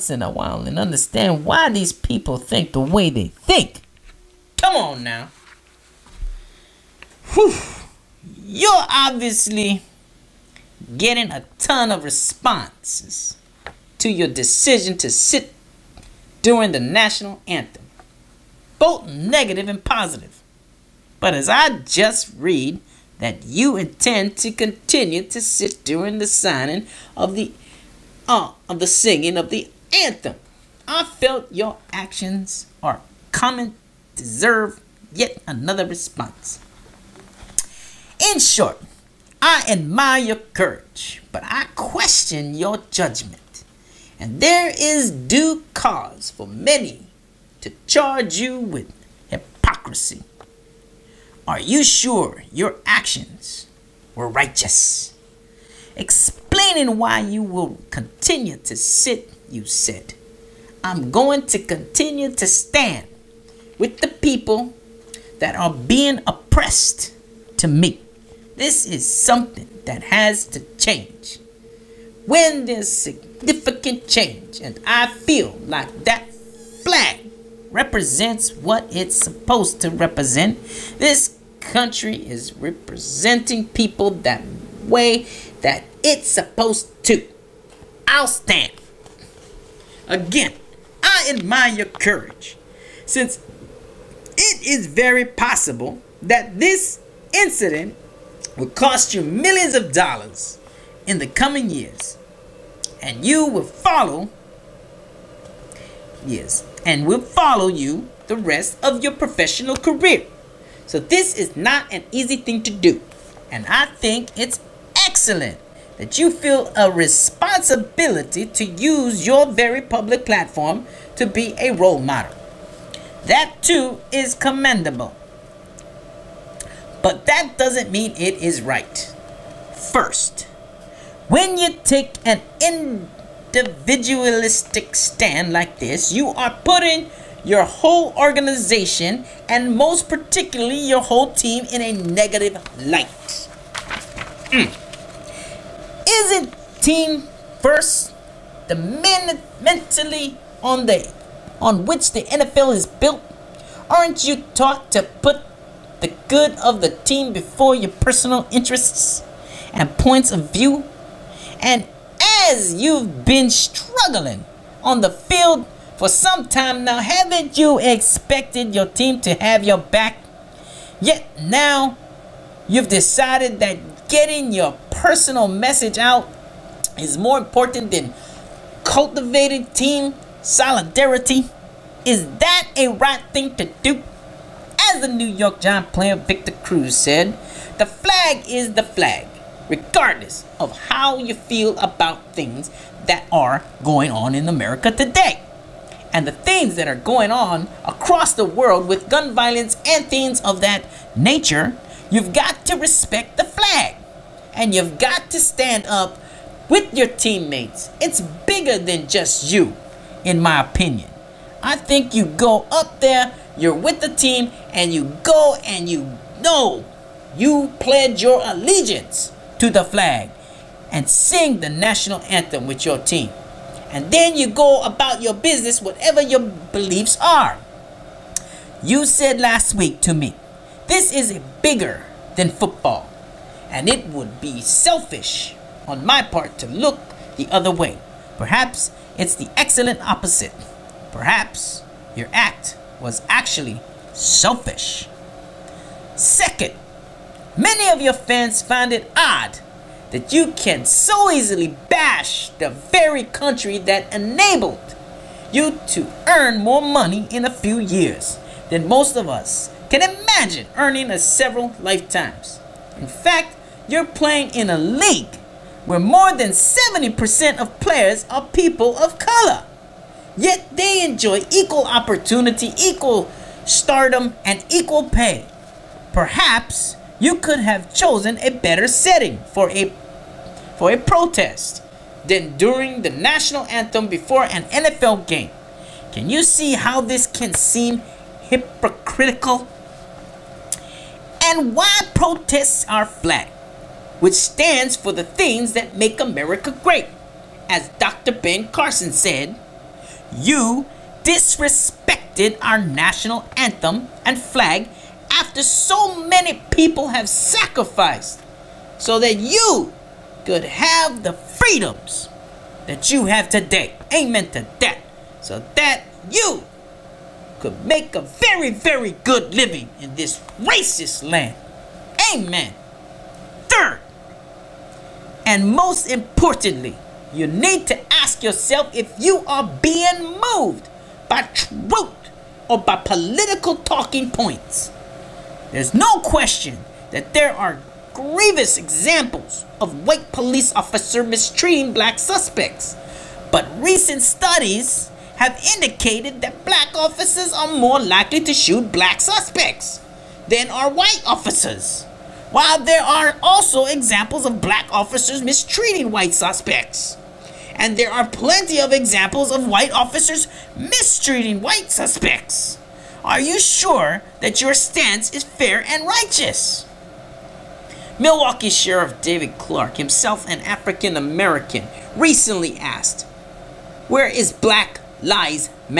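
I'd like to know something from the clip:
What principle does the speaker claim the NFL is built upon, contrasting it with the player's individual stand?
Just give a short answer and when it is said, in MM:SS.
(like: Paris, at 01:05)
team first, at 02:26.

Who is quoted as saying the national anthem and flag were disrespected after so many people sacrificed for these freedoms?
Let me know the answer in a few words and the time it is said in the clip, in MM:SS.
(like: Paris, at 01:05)
Dr. Ben Carson, at 04:57.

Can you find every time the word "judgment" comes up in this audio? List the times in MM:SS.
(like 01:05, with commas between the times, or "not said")
00:42.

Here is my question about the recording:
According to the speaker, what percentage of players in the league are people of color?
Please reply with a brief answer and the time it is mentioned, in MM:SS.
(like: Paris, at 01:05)
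more than 70%, at 04:25.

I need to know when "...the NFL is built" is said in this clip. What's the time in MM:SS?
02:32.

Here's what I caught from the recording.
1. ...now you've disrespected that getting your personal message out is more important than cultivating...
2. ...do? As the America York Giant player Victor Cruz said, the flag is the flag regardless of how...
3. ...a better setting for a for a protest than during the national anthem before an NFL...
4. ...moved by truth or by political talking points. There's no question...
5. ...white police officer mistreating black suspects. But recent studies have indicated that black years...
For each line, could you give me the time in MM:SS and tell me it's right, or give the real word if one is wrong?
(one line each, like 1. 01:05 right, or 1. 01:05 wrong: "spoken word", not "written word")
1. 02:51 wrong: "decided", not "disrespected"
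2. 03:03 wrong: "New", not "America"
3. 04:38 right
4. 05:30 right
5. 05:40 wrong: "officers", not "years".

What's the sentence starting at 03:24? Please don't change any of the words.
And you've got to stand up with your teammates.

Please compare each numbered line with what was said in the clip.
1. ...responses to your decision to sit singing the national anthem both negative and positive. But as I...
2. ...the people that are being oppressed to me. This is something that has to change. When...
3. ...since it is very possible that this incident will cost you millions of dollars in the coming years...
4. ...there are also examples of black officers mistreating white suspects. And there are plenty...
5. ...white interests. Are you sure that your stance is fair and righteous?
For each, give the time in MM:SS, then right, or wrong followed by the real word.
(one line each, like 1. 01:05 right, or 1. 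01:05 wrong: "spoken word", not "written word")
1. 00:12 wrong: "during", not "singing"
2. 01:03 right
3. 01:33 right
4. 05:52 right
5. 06:01 wrong: "suspects", not "interests".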